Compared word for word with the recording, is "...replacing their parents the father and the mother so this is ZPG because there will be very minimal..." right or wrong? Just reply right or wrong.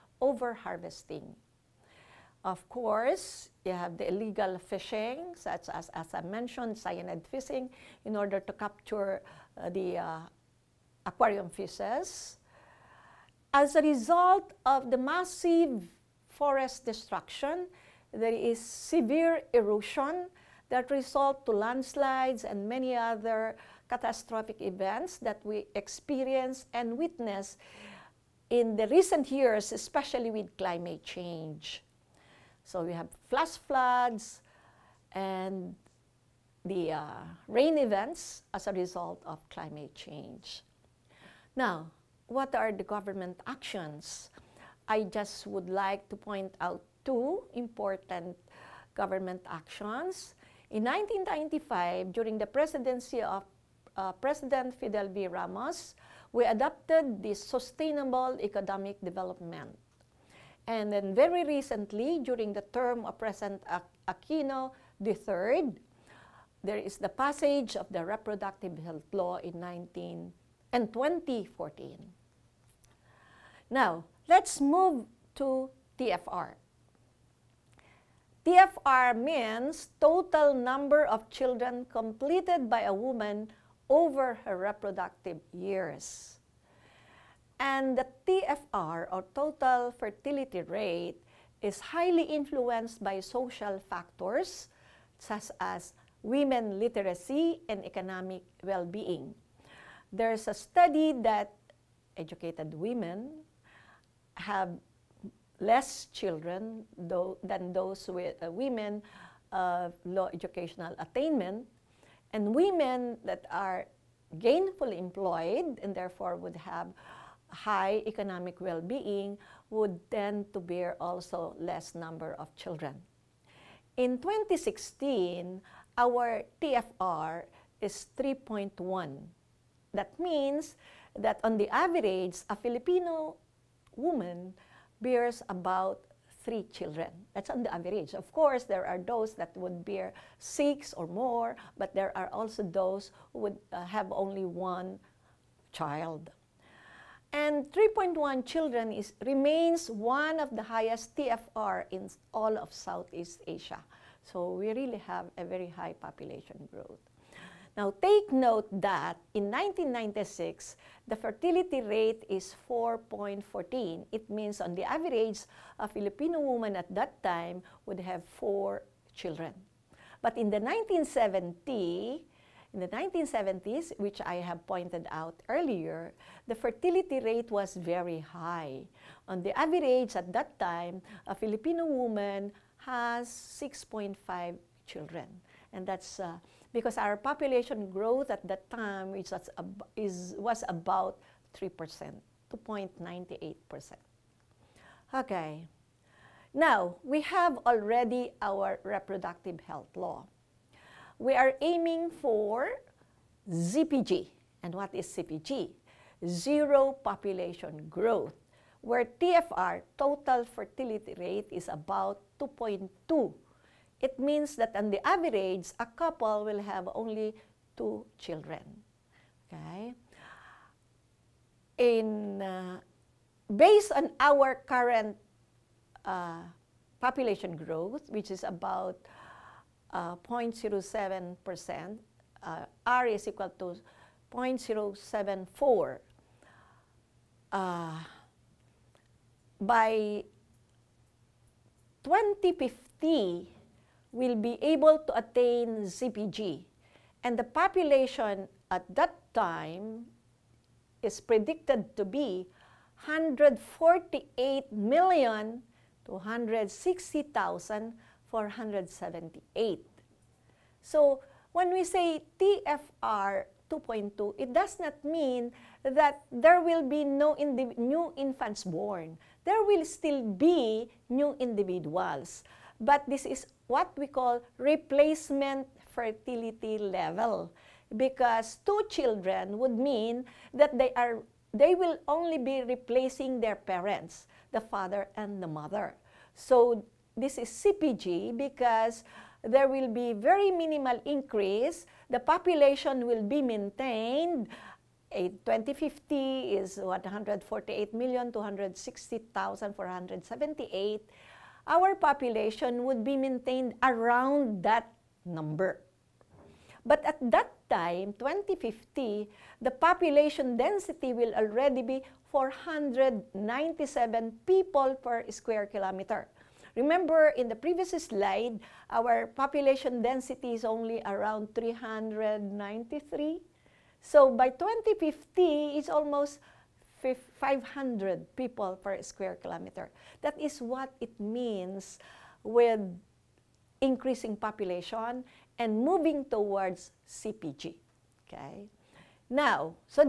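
right.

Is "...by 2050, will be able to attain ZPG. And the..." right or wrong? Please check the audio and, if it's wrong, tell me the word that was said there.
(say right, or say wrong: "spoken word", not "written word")
right.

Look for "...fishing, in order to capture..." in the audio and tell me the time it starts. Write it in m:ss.
0:07.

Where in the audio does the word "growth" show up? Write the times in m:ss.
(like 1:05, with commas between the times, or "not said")
2:36, 3:07, 3:27, 3:47.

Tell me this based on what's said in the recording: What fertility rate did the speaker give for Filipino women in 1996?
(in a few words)
4.14.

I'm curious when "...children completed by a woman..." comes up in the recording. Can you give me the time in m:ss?
1:21.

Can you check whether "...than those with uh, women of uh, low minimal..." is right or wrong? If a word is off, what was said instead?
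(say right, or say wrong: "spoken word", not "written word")
wrong: "educational", not "minimal".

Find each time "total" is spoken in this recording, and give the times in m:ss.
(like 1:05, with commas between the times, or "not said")
1:20, 1:29, 3:29.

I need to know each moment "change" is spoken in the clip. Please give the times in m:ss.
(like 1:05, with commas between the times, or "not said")
0:31, 0:39.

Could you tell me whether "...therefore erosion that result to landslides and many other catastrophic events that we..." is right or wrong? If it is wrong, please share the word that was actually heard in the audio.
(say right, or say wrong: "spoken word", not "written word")
wrong: "severe", not "therefore".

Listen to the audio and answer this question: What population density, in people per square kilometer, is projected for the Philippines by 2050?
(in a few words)
497.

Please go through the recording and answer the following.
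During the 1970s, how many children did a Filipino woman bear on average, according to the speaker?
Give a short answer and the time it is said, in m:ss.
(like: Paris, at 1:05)
6.5, at 3:03.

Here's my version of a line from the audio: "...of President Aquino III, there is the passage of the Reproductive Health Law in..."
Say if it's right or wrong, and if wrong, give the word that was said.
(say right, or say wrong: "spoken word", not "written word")
right.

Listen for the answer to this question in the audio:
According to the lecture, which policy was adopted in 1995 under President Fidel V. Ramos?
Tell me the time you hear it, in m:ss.
0:57.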